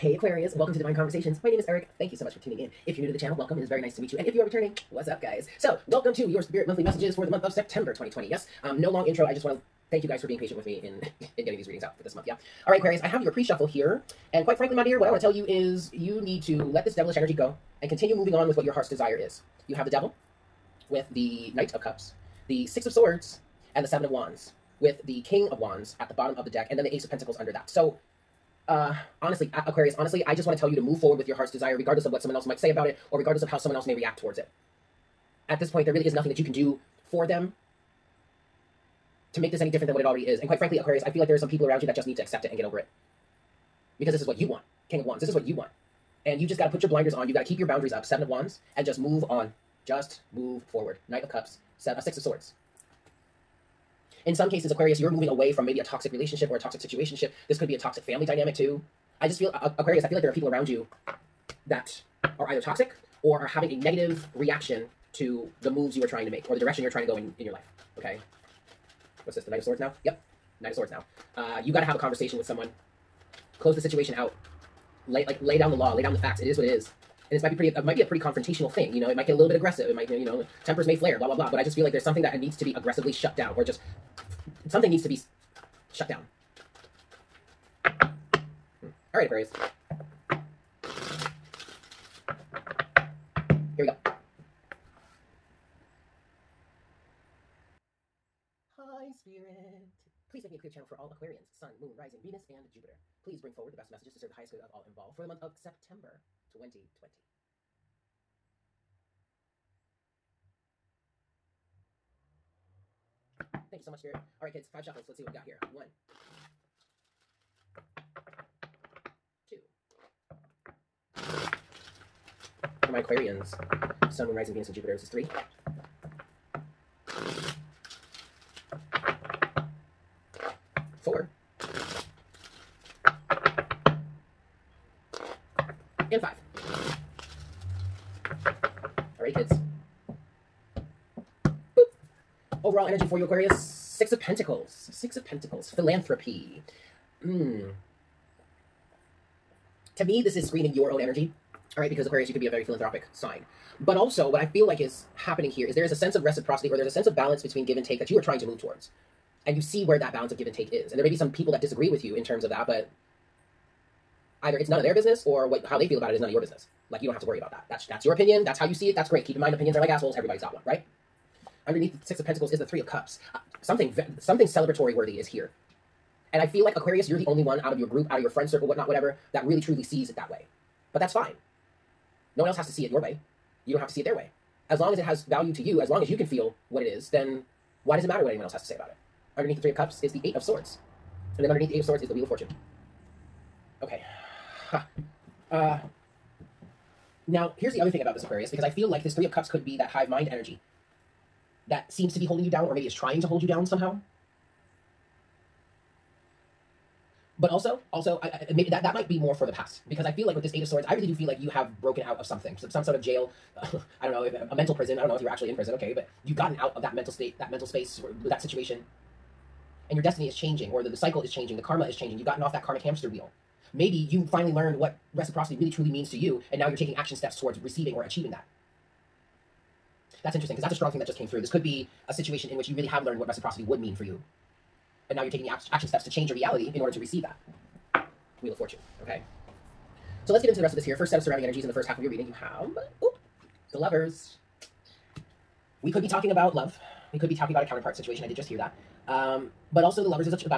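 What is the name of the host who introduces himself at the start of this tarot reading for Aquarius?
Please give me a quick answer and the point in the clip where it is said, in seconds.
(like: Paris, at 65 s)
Eric, at 1 s.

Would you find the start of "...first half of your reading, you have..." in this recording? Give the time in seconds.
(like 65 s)
241 s.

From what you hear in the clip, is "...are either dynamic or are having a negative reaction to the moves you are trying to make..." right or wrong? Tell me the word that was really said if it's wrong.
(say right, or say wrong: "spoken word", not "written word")
wrong: "toxic", not "dynamic".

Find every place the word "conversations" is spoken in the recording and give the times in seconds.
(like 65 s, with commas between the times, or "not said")
0 s, 71 s.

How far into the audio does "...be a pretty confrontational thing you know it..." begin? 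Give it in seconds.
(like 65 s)
77 s.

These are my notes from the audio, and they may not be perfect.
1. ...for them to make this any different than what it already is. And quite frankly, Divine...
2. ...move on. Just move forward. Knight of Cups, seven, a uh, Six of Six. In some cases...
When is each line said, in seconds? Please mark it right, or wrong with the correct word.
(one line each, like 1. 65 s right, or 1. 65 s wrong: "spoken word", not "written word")
1. 37 s wrong: "Aquarius", not "Divine"
2. 48 s wrong: "Swords", not "Six".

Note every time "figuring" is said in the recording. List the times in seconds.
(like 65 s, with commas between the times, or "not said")
not said.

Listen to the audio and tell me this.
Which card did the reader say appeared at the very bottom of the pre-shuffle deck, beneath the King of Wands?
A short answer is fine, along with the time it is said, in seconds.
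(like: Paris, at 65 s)
Ace of Pentacles, at 26 s.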